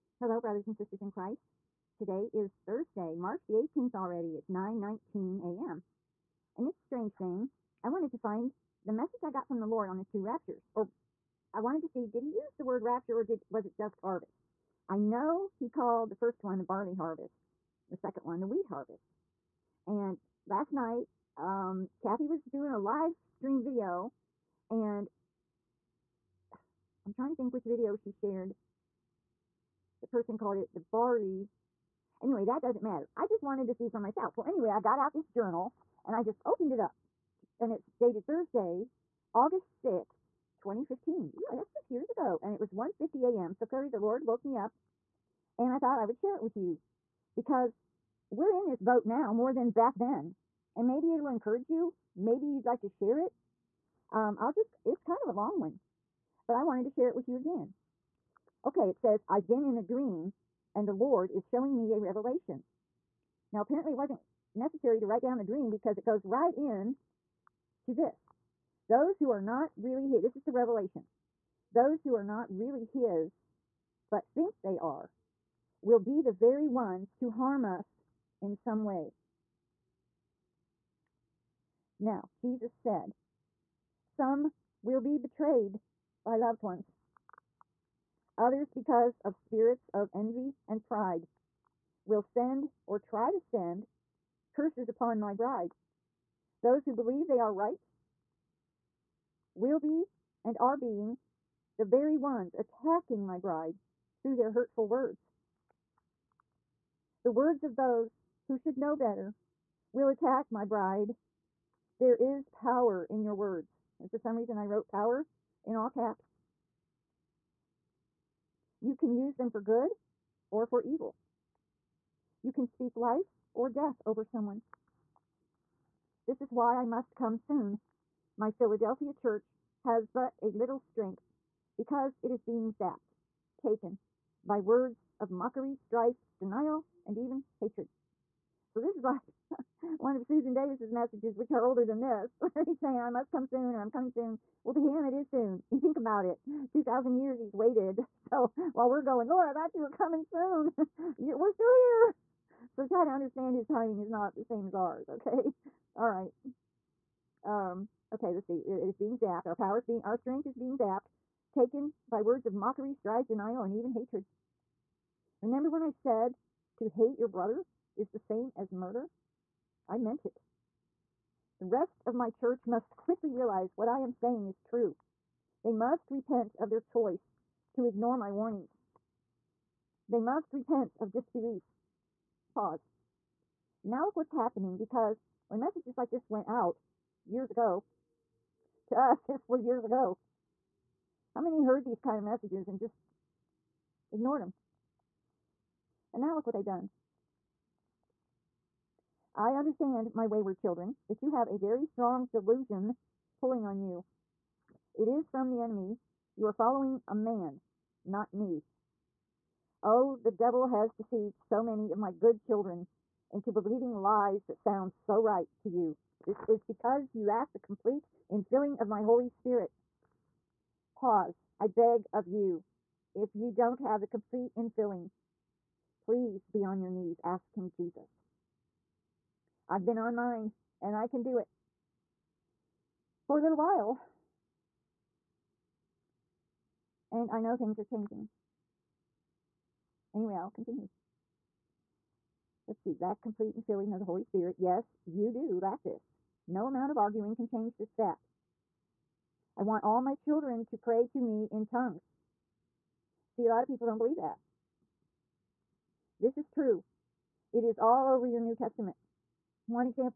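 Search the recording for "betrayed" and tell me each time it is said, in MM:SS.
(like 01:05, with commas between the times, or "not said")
01:25.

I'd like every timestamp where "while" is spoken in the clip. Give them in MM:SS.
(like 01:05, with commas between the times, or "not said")
02:28, 03:53.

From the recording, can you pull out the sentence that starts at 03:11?
How many heard these kind of messages and just ignored them?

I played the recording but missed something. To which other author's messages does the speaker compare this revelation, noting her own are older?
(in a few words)
Susan Davis.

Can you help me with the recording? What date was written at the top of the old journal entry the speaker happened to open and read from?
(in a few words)
August 6th, 2015.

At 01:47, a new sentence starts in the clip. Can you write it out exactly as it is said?
The words of those who should know better will attack my bride.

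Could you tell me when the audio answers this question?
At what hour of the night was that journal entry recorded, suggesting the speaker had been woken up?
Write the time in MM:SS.
00:42.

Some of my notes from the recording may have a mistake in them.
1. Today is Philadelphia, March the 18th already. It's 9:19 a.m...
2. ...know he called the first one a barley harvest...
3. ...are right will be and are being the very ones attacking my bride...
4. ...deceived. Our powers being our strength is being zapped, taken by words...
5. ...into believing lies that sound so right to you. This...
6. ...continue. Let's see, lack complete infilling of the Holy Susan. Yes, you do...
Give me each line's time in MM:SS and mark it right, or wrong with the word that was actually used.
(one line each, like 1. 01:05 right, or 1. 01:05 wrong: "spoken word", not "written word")
1. 00:01 wrong: "Thursday", not "Philadelphia"
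2. 00:14 right
3. 01:37 right
4. 02:39 wrong: "zapped", not "deceived"
5. 03:33 right
6. 04:00 wrong: "Spirit", not "Susan".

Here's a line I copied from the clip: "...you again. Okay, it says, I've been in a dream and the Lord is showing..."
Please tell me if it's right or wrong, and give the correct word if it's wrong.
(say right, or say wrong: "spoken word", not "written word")
right.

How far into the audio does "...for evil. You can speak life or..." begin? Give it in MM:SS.
02:00.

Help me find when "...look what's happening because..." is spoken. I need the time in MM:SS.
03:04.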